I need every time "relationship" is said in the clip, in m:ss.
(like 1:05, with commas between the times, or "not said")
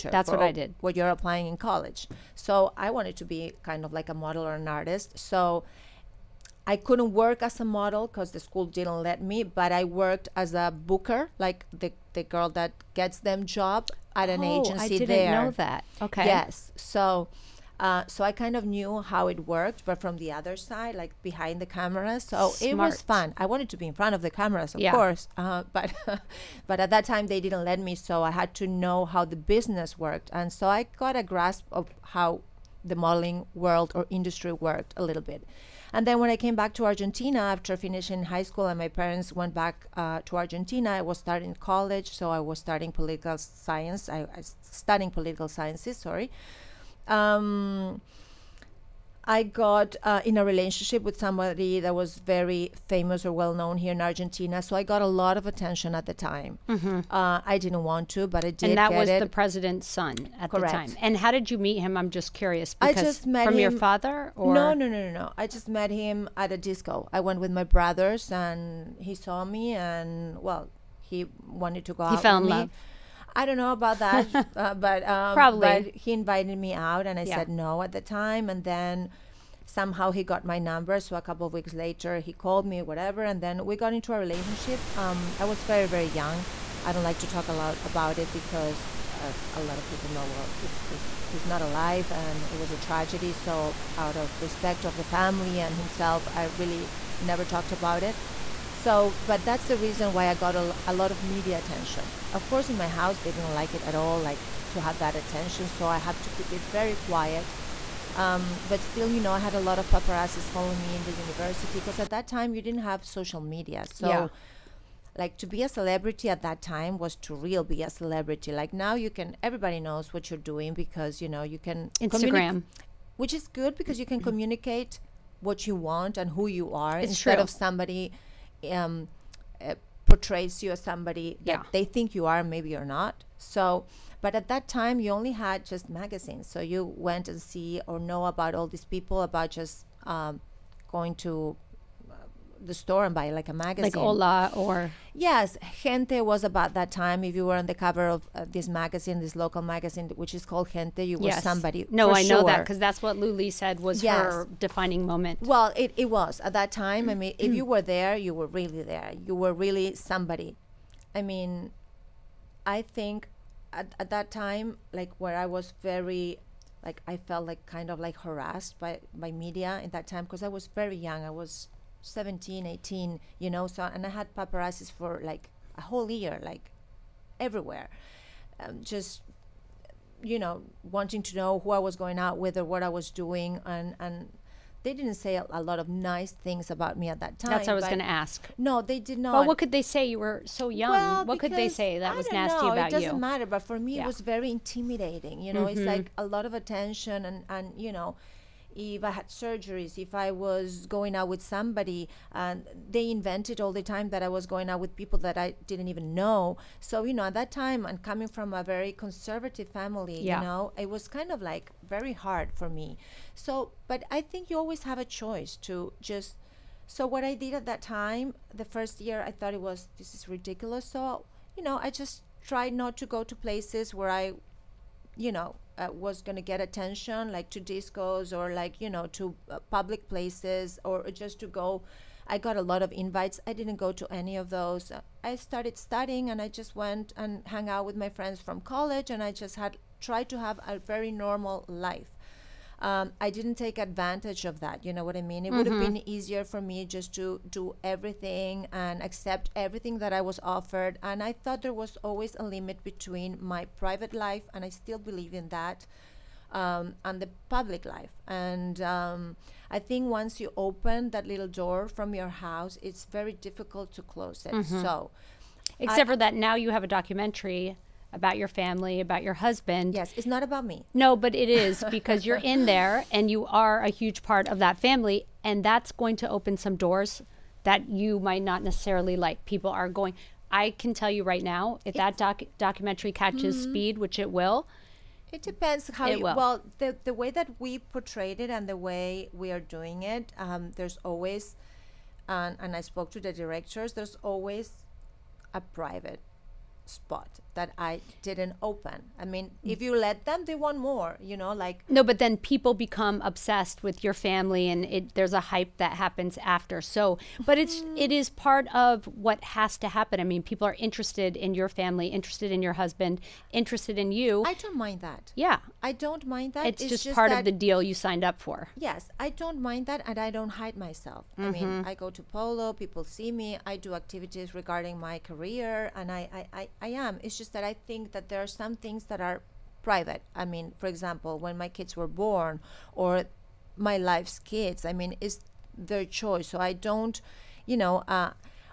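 0:50, 1:24.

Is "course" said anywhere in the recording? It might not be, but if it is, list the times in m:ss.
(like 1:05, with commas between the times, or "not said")
0:24, 1:42.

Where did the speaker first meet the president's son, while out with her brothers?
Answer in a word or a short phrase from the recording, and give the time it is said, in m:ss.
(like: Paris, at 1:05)
A disco, at 1:06.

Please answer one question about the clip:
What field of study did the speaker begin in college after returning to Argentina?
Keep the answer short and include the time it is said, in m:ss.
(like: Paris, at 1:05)
Political science, at 0:42.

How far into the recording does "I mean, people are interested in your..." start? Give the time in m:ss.
5:10.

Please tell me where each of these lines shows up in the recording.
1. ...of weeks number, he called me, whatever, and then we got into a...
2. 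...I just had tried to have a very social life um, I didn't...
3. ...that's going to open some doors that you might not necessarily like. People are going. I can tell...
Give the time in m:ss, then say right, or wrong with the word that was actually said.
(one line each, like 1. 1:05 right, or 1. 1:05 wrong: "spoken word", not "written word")
1. 1:21 wrong: "later", not "number"
2. 3:59 wrong: "normal", not "social"
3. 4:35 right.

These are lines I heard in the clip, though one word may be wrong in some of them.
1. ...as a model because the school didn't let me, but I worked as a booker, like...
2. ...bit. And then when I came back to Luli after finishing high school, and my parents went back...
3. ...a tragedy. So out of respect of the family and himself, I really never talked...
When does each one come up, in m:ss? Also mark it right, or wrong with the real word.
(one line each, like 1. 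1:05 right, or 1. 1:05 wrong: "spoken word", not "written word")
1. 0:07 right
2. 0:35 wrong: "Argentina", not "Luli"
3. 1:32 right.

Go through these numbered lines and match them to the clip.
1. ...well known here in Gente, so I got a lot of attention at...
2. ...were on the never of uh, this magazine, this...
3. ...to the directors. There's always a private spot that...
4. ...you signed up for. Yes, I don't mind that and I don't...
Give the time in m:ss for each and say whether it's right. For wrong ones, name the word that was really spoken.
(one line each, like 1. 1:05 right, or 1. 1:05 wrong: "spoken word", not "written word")
1. 0:53 wrong: "Argentina", not "Gente"
2. 2:27 wrong: "cover", not "never"
3. 4:53 right
4. 5:17 right.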